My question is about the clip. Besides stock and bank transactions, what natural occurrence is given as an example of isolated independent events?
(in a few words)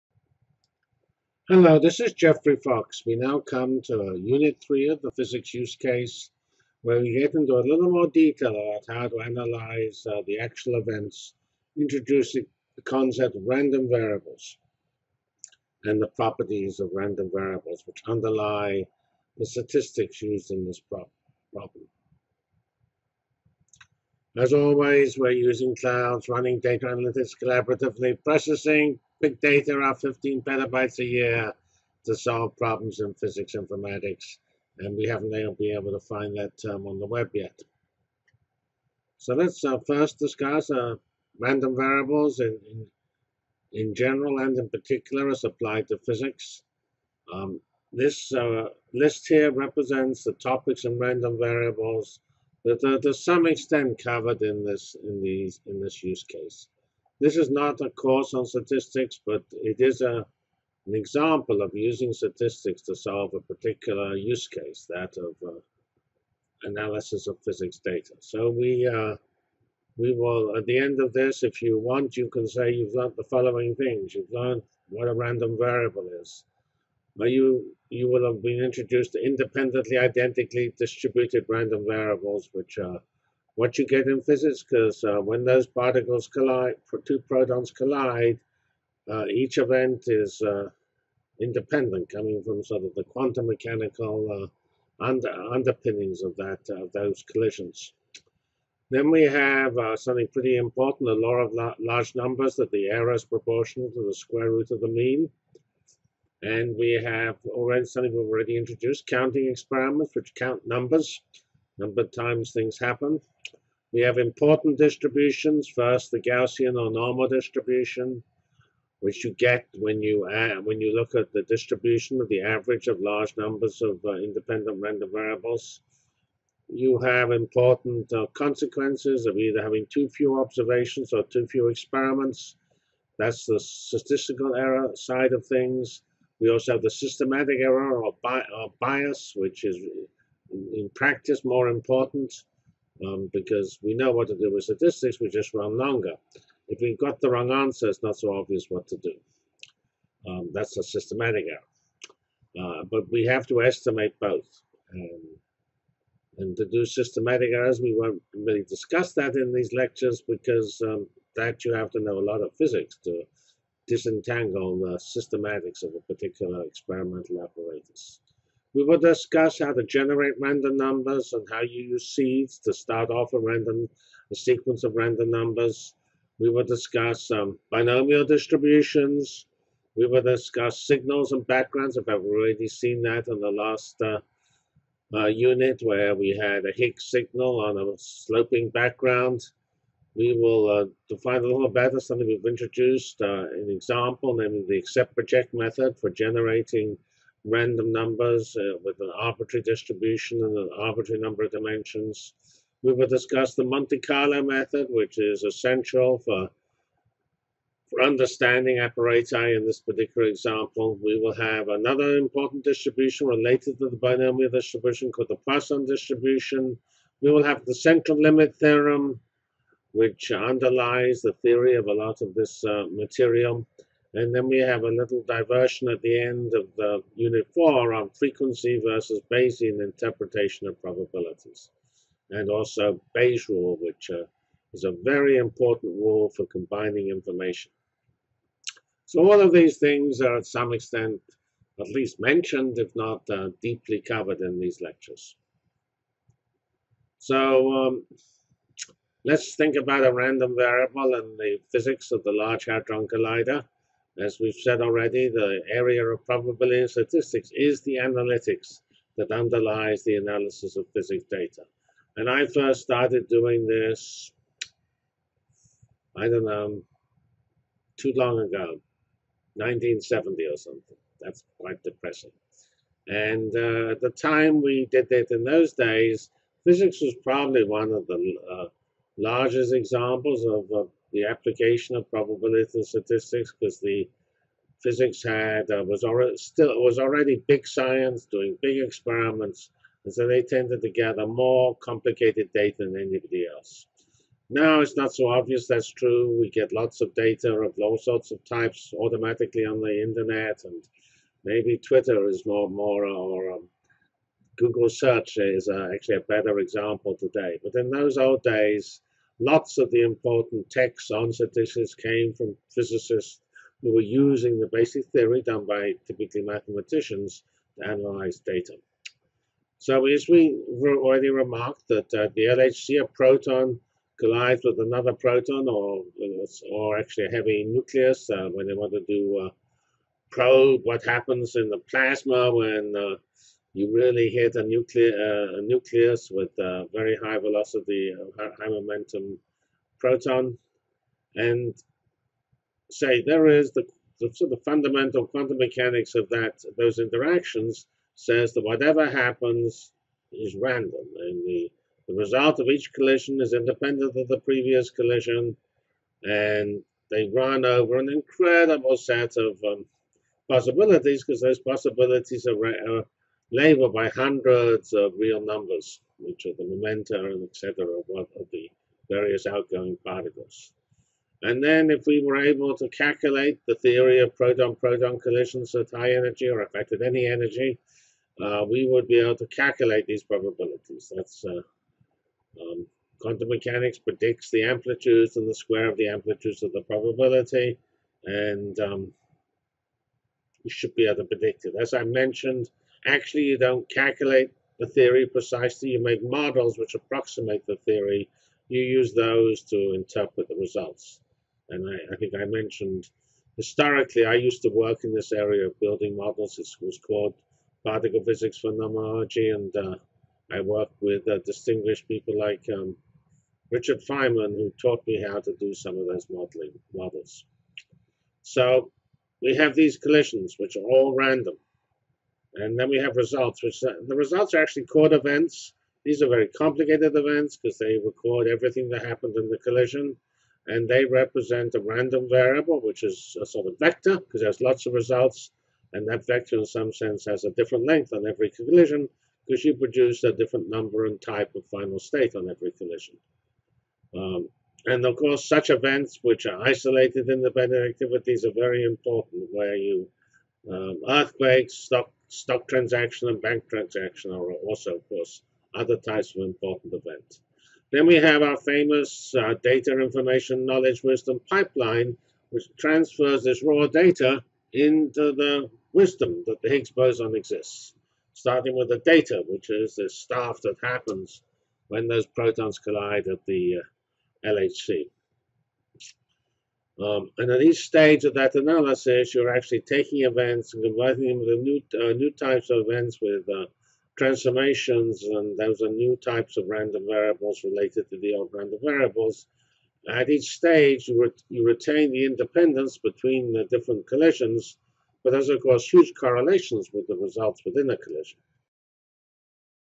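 Earthquakes.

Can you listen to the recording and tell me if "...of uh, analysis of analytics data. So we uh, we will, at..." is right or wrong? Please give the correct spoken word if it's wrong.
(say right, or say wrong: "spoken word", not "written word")
wrong: "physics", not "analytics".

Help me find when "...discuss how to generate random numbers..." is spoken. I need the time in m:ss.
2:48.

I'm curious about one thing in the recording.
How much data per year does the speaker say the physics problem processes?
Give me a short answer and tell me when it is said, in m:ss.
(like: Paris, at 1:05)
15 petabytes, at 0:29.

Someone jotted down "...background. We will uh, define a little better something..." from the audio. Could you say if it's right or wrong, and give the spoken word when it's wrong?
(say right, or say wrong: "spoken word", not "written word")
right.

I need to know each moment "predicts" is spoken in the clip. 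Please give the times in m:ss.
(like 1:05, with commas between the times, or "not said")
6:23, 6:31.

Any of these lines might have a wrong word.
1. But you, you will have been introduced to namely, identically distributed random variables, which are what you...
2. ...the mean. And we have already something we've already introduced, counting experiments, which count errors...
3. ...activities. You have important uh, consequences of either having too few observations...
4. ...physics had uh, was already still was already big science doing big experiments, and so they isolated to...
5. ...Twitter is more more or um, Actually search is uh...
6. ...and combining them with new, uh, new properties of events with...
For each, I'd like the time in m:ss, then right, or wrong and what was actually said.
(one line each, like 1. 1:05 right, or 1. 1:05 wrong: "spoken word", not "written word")
1. 1:17 wrong: "independently", not "namely"
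2. 1:44 wrong: "numbers", not "errors"
3. 2:05 wrong: "variables", not "activities"
4. 4:44 wrong: "tended", not "isolated"
5. 5:01 wrong: "Google", not "Actually"
6. 8:00 wrong: "types", not "properties".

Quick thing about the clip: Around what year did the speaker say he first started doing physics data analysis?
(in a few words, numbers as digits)
1970.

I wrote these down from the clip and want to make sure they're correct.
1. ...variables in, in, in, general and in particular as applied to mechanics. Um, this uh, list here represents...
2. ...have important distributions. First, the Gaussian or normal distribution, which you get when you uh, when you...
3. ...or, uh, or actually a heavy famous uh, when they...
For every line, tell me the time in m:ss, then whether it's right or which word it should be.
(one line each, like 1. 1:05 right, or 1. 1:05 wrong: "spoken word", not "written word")
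1. 0:41 wrong: "physics", not "mechanics"
2. 1:54 right
3. 5:25 wrong: "nucleus", not "famous".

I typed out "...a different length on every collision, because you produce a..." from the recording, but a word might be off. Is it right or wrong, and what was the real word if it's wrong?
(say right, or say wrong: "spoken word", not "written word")
right.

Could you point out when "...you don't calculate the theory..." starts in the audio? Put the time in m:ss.
6:33.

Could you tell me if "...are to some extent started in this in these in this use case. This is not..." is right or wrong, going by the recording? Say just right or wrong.
wrong.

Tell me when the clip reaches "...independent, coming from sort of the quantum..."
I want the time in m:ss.
1:31.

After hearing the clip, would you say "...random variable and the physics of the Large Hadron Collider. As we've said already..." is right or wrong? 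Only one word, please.
right.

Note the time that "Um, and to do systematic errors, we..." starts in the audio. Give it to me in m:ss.
2:34.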